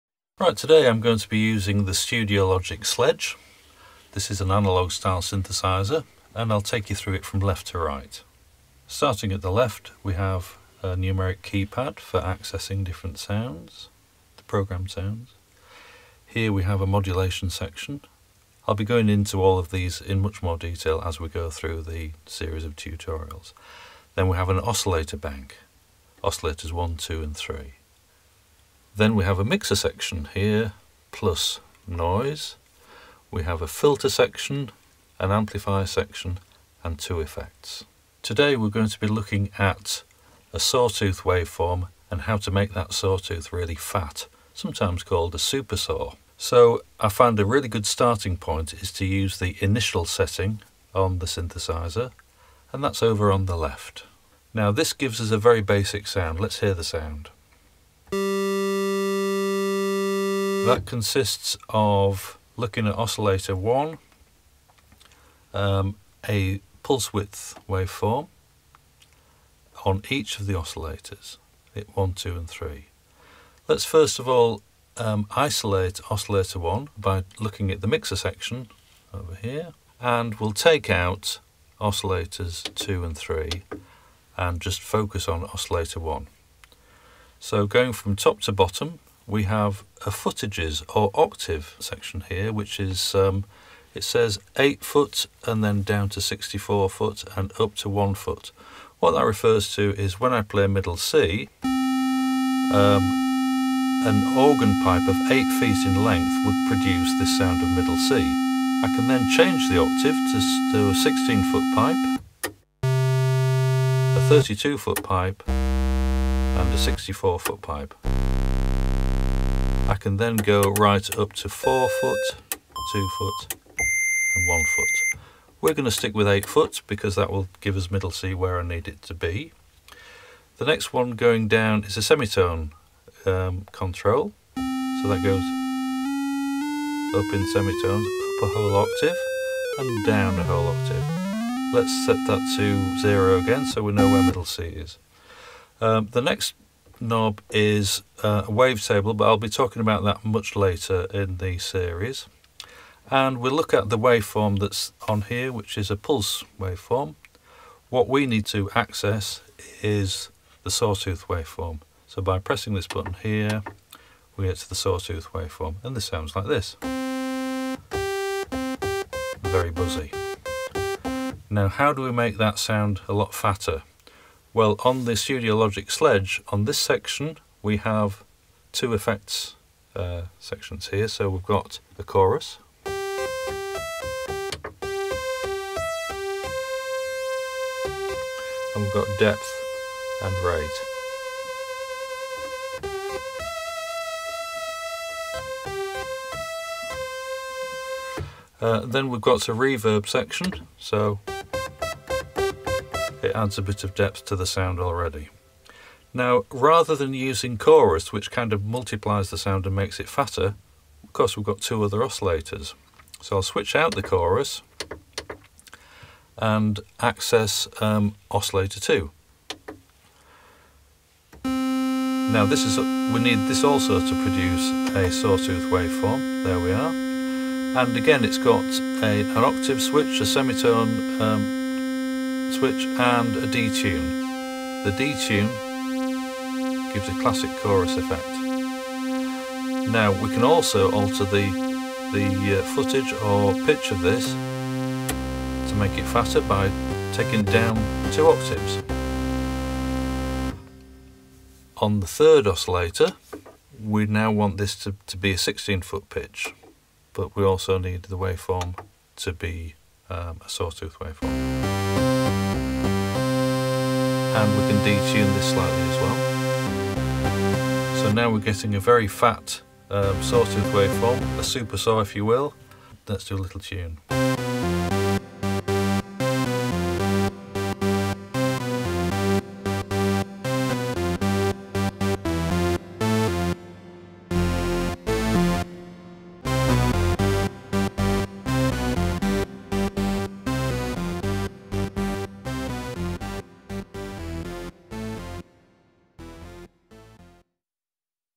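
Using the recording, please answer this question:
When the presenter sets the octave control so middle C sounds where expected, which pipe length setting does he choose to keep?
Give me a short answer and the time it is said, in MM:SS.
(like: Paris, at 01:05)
8 foot, at 02:06.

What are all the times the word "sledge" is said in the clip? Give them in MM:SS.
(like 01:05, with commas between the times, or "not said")
00:02, 02:55.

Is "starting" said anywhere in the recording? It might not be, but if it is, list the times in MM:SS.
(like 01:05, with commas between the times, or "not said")
00:08, 00:47.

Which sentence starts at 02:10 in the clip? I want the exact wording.
The next one going down is a semitone um, control.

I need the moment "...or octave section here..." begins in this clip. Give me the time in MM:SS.
01:30.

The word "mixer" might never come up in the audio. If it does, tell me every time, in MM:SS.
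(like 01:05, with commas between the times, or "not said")
00:29, 01:17.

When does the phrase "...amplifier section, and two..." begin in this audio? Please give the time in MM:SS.
00:35.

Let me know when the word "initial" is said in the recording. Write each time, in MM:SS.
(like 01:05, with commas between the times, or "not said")
00:49.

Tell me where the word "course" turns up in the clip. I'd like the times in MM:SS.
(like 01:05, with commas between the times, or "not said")
03:31.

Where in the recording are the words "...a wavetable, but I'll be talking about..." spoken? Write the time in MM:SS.
02:28.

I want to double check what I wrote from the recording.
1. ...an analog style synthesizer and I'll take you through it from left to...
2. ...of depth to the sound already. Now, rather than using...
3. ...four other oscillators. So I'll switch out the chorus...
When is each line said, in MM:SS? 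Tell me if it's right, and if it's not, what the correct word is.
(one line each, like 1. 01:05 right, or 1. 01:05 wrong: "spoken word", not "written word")
1. 00:04 right
2. 03:23 right
3. 03:31 wrong: "two", not "four".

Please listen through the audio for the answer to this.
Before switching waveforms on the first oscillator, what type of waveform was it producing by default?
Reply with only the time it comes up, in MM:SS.
02:35.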